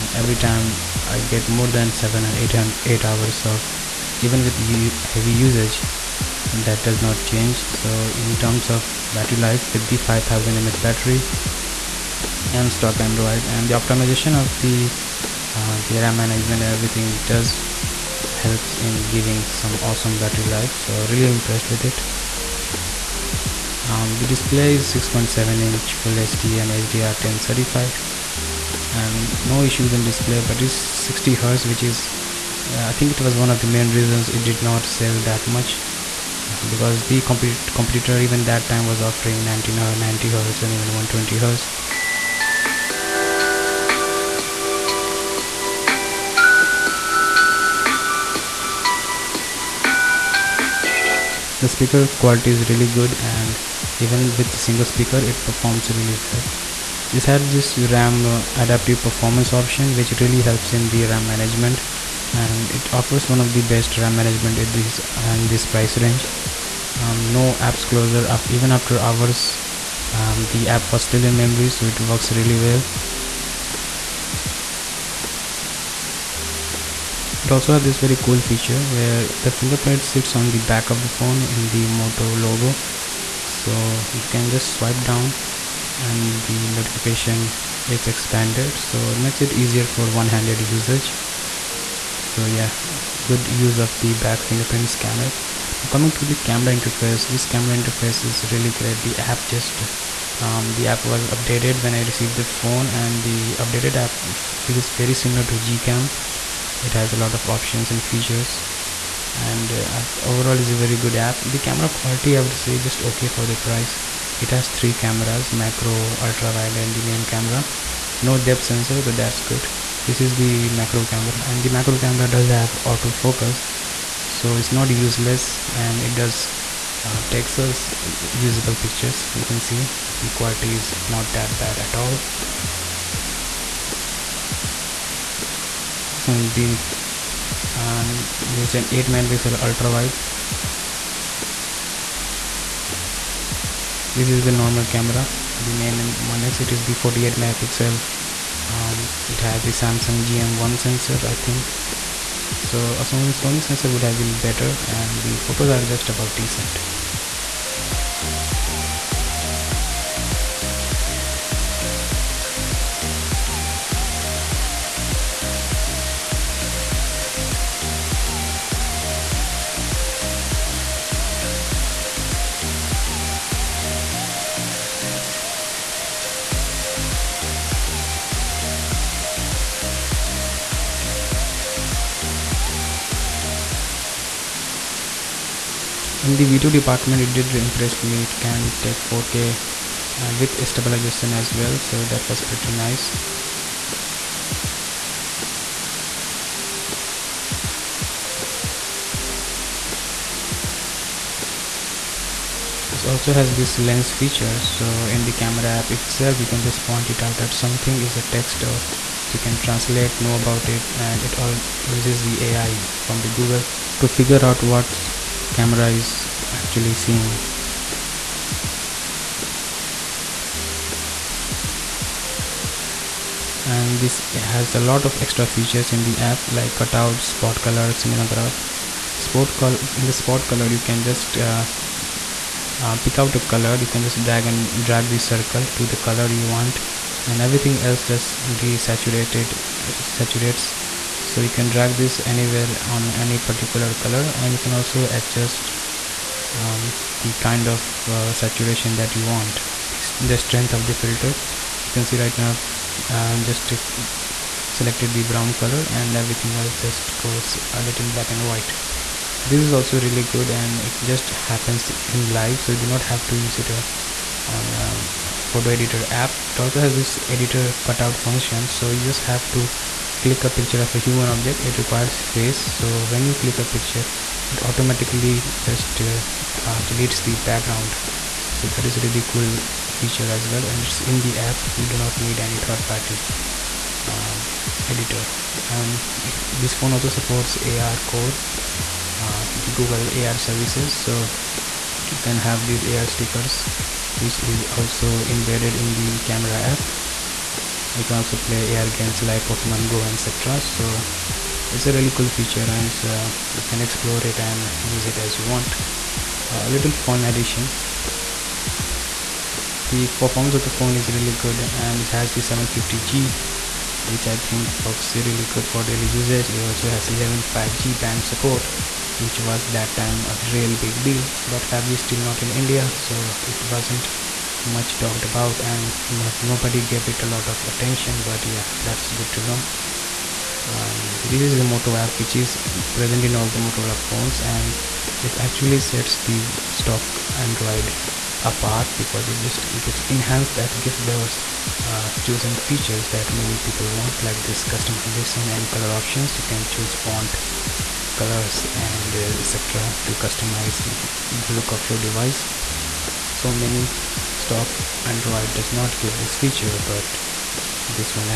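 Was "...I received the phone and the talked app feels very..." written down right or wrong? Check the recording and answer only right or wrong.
wrong.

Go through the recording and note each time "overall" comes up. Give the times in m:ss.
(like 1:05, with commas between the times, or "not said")
1:50.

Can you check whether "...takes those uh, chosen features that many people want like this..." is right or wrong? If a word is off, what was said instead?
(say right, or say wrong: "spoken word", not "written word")
wrong: "gives", not "takes".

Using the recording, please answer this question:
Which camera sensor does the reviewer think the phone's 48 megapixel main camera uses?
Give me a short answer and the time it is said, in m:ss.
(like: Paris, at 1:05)
Samsung GM1, at 2:29.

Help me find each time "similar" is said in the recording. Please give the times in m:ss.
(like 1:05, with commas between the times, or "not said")
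1:45.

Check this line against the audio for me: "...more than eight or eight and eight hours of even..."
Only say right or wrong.
wrong.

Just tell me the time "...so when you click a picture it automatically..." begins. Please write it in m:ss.
4:32.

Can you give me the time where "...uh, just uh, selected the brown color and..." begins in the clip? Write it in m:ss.
4:13.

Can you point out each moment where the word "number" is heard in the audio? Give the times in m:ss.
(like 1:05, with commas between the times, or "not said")
not said.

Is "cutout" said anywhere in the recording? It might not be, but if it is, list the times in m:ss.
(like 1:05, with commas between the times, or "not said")
3:46, 4:27.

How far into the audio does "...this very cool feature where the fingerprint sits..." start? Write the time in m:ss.
1:17.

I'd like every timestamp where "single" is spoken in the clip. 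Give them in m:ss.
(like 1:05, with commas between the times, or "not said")
0:54.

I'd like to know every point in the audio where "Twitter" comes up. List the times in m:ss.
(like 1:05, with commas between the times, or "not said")
not said.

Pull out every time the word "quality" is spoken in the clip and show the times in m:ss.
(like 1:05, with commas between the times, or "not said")
0:52, 1:51, 2:10.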